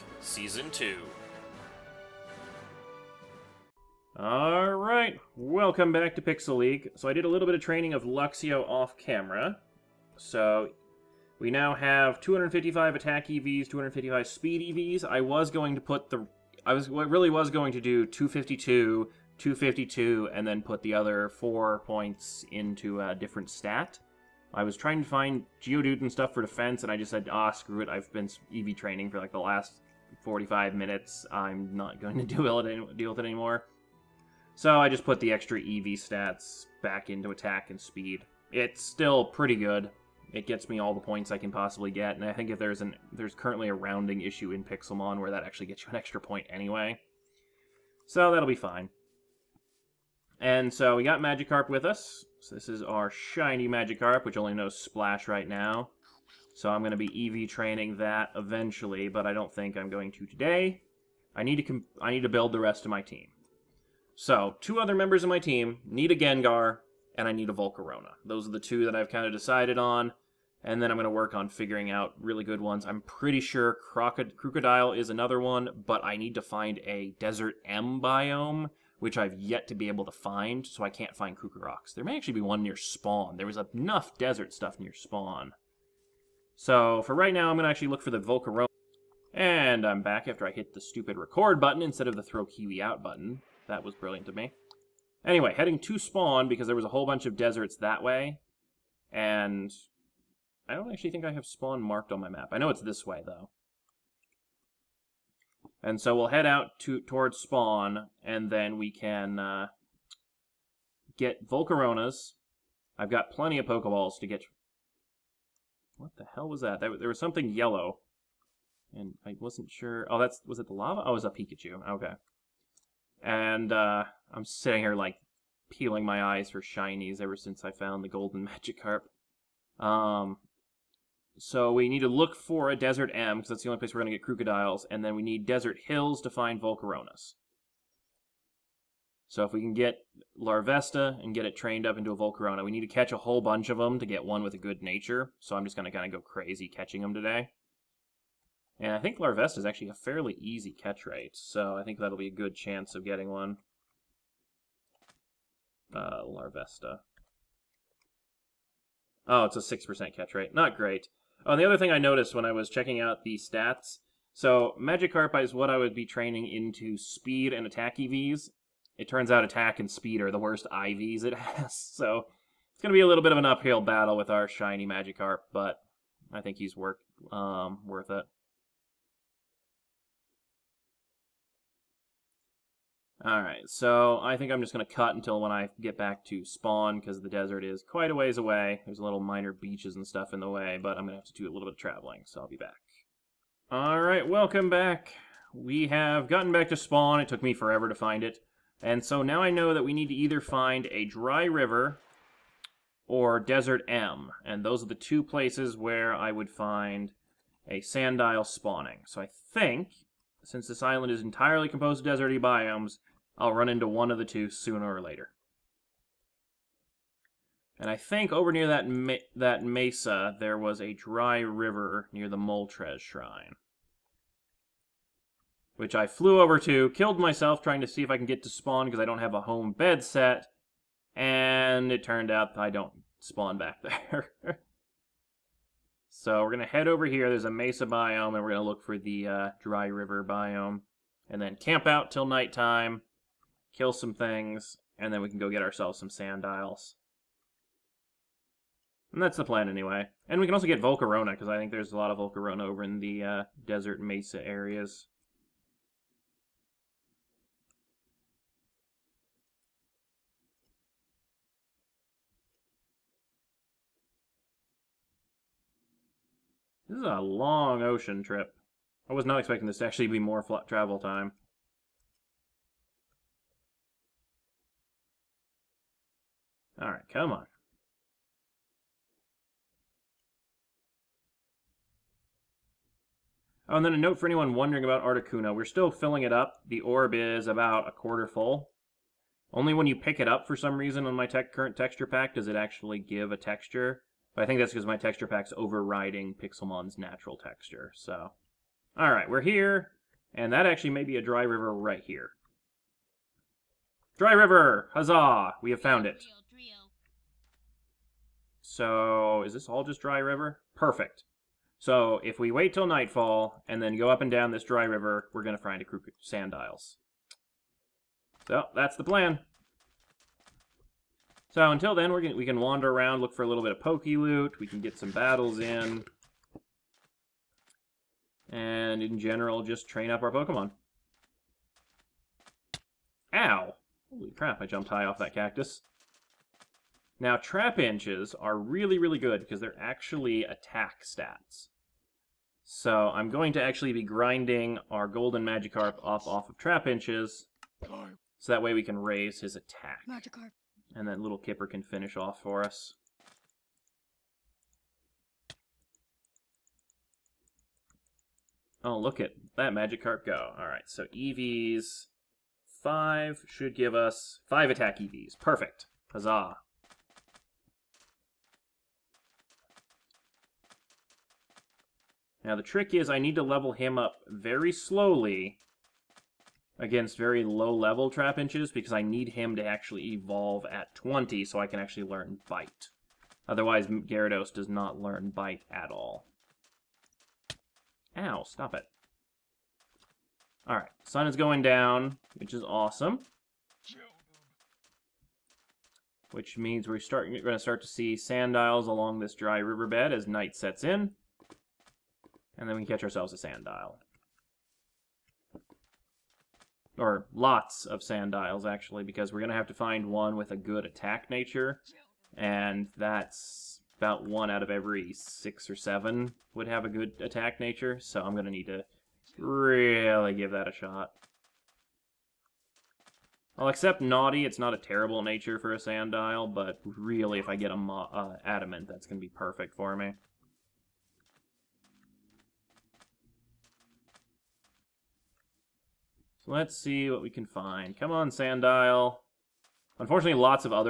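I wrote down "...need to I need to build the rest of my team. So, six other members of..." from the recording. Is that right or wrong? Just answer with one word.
wrong.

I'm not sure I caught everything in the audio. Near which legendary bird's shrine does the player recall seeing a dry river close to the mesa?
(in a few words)
Moltres.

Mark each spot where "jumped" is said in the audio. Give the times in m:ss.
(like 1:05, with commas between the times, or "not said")
5:34.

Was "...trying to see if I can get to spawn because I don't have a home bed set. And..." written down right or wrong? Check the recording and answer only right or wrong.
right.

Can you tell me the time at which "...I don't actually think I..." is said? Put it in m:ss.
1:40.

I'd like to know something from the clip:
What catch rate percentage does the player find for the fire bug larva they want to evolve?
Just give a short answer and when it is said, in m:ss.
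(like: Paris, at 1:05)
6%, at 2:39.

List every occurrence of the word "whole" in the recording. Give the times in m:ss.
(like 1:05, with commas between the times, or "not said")
1:36, 2:23.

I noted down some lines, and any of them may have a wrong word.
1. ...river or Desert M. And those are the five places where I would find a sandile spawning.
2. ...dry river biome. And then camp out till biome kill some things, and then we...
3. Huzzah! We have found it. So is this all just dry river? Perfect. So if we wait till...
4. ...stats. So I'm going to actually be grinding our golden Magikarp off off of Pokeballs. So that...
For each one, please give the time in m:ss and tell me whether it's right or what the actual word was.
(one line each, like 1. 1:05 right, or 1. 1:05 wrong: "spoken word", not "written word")
1. 3:21 wrong: "two", not "five"
2. 3:59 wrong: "nighttime", not "biome"
3. 5:04 right
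4. 5:41 wrong: "Trapinches", not "Pokeballs".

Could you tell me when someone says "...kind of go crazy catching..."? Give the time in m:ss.
2:25.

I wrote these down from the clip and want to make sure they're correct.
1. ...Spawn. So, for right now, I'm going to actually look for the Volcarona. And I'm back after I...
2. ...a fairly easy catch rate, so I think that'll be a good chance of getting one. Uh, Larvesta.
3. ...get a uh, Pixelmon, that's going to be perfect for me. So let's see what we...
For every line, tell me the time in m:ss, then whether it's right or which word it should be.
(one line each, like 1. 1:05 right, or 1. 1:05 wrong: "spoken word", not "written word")
1. 1:24 right
2. 2:29 right
3. 7:07 wrong: "Adamant", not "Pixelmon".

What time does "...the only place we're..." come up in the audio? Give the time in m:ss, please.
2:13.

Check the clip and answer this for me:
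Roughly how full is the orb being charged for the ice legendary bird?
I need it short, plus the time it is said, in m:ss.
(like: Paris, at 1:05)
a quarter full, at 4:47.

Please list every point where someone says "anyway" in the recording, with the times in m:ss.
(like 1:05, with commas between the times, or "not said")
0:46, 1:35, 4:09.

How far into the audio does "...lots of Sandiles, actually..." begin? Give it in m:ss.
6:47.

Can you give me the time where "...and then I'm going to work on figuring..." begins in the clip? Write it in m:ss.
1:10.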